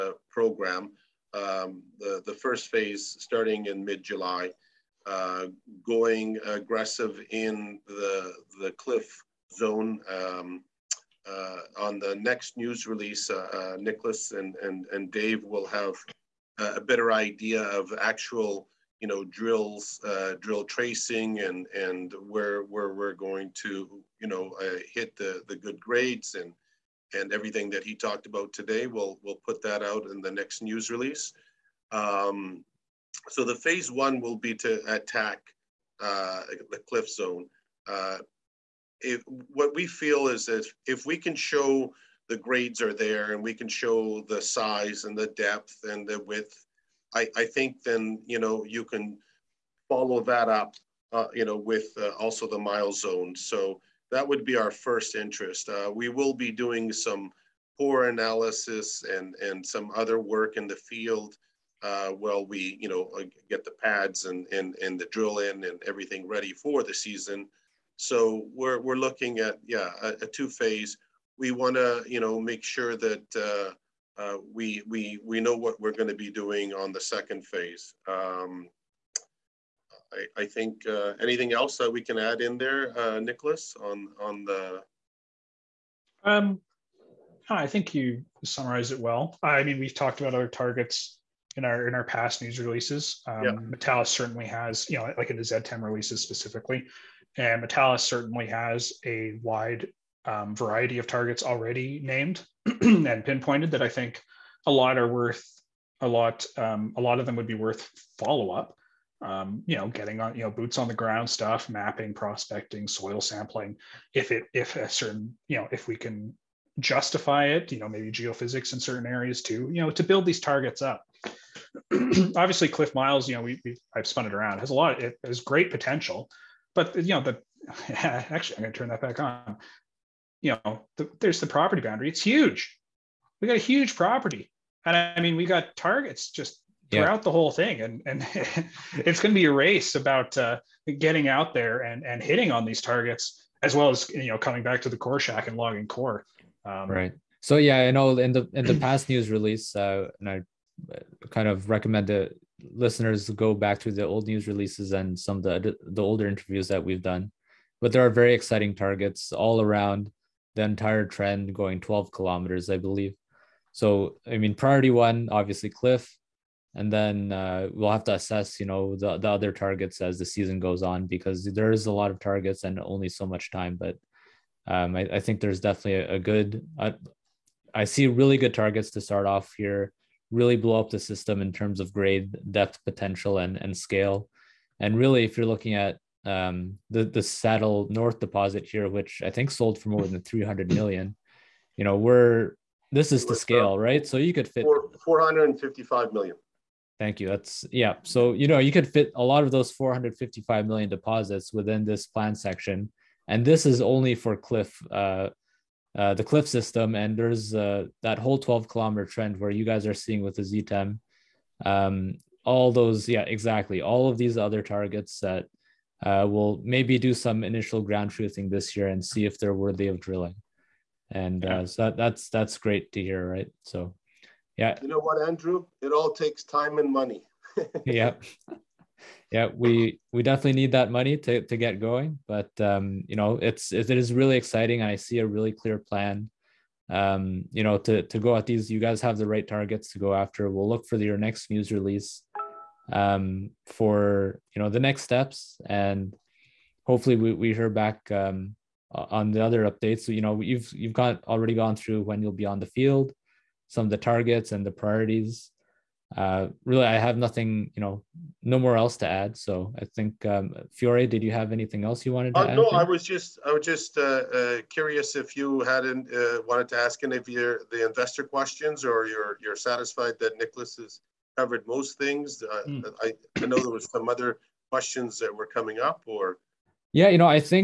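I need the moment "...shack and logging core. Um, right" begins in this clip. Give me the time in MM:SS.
02:25.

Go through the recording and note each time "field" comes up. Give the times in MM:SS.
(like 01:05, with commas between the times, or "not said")
01:00, 04:12.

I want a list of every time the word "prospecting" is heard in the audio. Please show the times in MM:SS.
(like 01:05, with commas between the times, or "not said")
01:52.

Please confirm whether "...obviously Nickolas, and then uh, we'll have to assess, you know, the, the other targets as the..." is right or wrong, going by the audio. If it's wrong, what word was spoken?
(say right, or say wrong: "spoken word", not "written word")
wrong: "Cliff", not "Nickolas".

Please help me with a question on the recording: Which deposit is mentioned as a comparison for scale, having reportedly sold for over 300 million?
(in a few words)
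Saddle North.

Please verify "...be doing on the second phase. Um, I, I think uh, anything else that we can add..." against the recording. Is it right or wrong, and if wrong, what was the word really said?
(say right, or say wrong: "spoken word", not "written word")
right.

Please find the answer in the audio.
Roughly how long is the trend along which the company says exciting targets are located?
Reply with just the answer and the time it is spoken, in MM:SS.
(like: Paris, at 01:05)
12 kilometers, at 02:41.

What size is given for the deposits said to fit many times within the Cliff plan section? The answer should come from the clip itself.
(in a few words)
455 million.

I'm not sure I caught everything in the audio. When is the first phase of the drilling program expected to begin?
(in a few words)
mid July.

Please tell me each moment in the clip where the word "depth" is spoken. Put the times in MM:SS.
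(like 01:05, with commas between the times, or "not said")
00:45, 03:02.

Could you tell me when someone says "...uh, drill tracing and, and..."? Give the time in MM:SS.
00:20.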